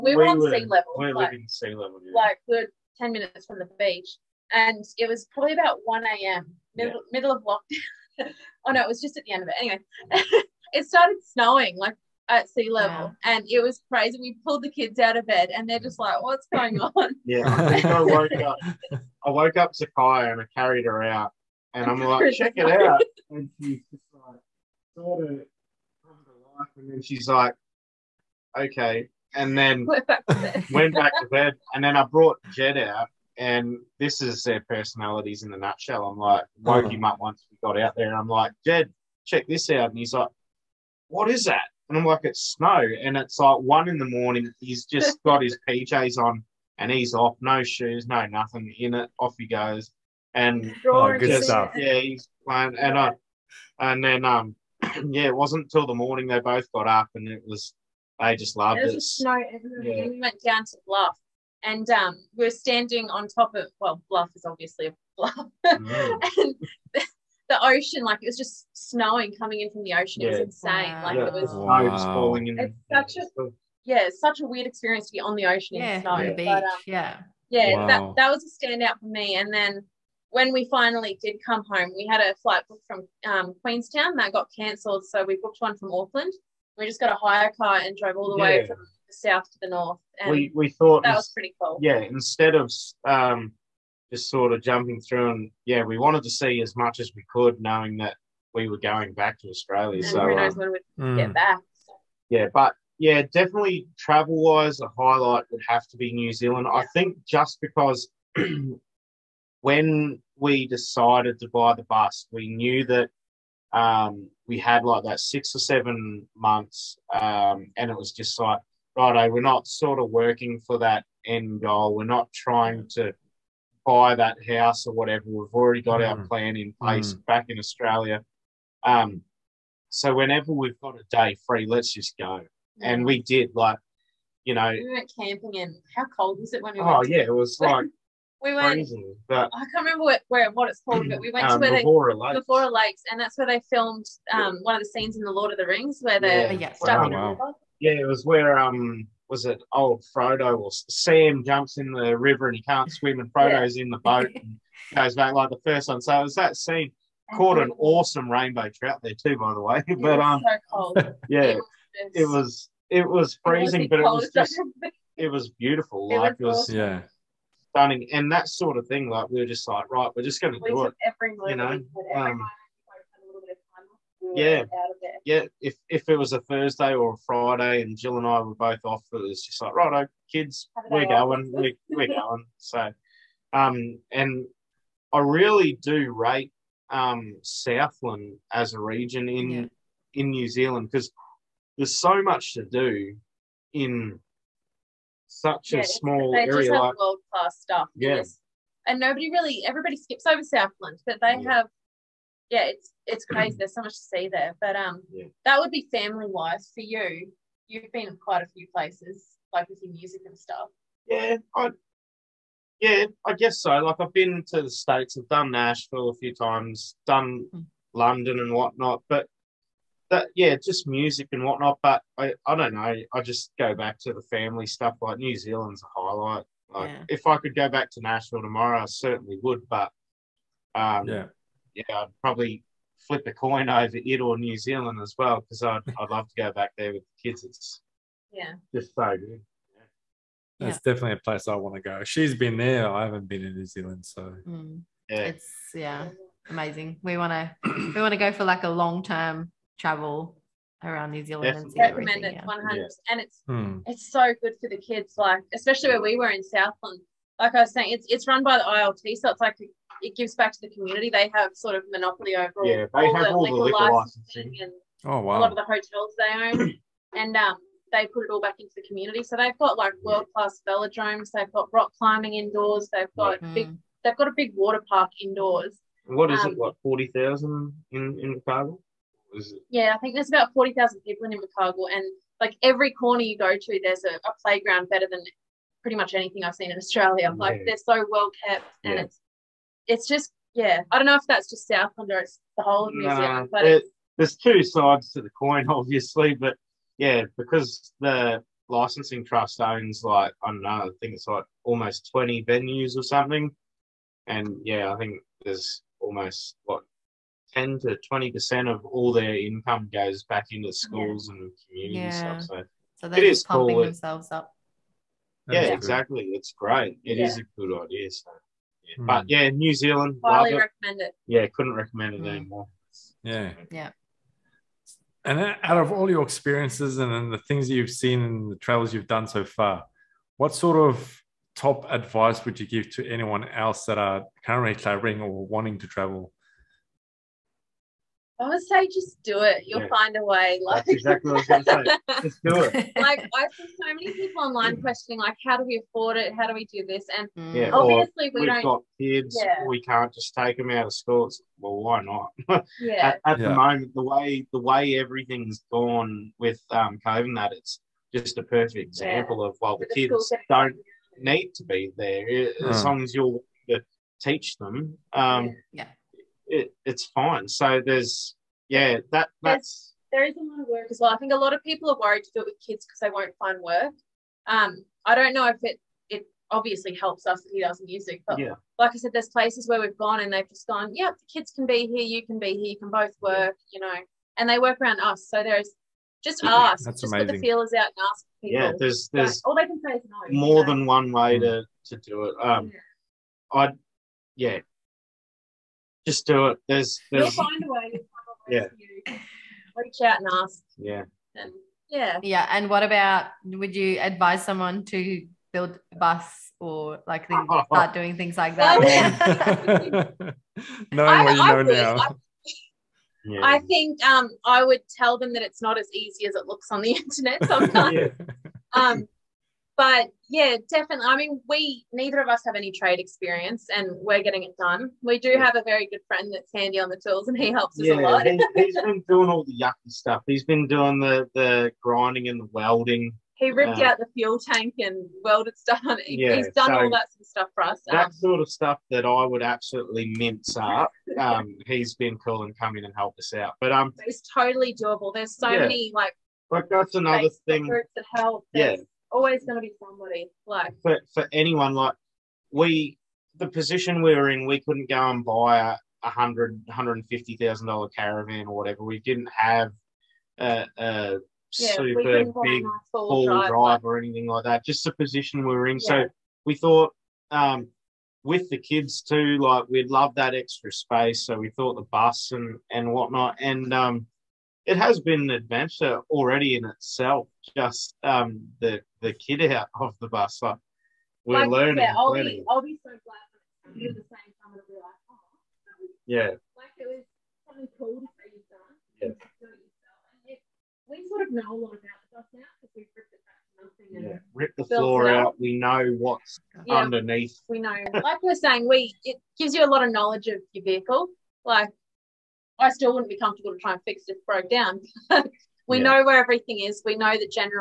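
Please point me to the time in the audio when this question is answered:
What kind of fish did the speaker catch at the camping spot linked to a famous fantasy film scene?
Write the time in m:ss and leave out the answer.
2:38.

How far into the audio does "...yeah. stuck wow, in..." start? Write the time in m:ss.
2:26.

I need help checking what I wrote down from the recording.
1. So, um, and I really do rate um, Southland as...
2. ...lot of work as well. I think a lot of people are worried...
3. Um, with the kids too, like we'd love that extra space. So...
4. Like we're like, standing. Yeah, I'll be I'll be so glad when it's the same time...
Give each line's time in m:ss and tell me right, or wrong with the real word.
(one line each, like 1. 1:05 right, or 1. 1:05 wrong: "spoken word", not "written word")
1. 3:02 right
2. 6:10 right
3. 7:47 right
4. 8:00 wrong: "learning", not "standing".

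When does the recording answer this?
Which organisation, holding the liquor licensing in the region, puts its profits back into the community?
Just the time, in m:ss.
4:18.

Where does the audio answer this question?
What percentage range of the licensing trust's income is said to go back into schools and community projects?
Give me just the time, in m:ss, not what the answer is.
5:07.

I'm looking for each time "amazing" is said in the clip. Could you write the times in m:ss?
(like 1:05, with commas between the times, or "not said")
4:06, 6:27.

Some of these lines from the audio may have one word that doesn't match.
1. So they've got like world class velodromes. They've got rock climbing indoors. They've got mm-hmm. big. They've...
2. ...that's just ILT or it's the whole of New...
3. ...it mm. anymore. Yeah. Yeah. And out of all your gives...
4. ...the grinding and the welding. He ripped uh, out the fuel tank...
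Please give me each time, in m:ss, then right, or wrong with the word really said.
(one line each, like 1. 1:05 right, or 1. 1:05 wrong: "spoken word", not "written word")
1. 4:29 right
2. 4:51 wrong: "Southland", not "ILT"
3. 5:22 wrong: "experiences", not "gives"
4. 7:11 right.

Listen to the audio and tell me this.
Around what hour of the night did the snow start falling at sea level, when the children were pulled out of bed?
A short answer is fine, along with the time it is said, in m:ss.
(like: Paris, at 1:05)
1 a.m., at 0:05.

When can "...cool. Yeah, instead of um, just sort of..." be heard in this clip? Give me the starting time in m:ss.
1:31.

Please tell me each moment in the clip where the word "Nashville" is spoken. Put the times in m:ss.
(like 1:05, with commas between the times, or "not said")
3:35, 3:48.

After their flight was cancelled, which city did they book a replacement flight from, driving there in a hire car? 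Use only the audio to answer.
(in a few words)
Auckland.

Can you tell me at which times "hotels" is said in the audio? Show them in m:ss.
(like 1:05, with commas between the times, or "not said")
4:25.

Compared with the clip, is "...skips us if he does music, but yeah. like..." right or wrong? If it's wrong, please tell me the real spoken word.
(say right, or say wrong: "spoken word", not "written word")
wrong: "helps", not "skips".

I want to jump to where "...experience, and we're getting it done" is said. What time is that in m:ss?
7:02.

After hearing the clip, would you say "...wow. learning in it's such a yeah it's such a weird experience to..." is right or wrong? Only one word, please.
wrong.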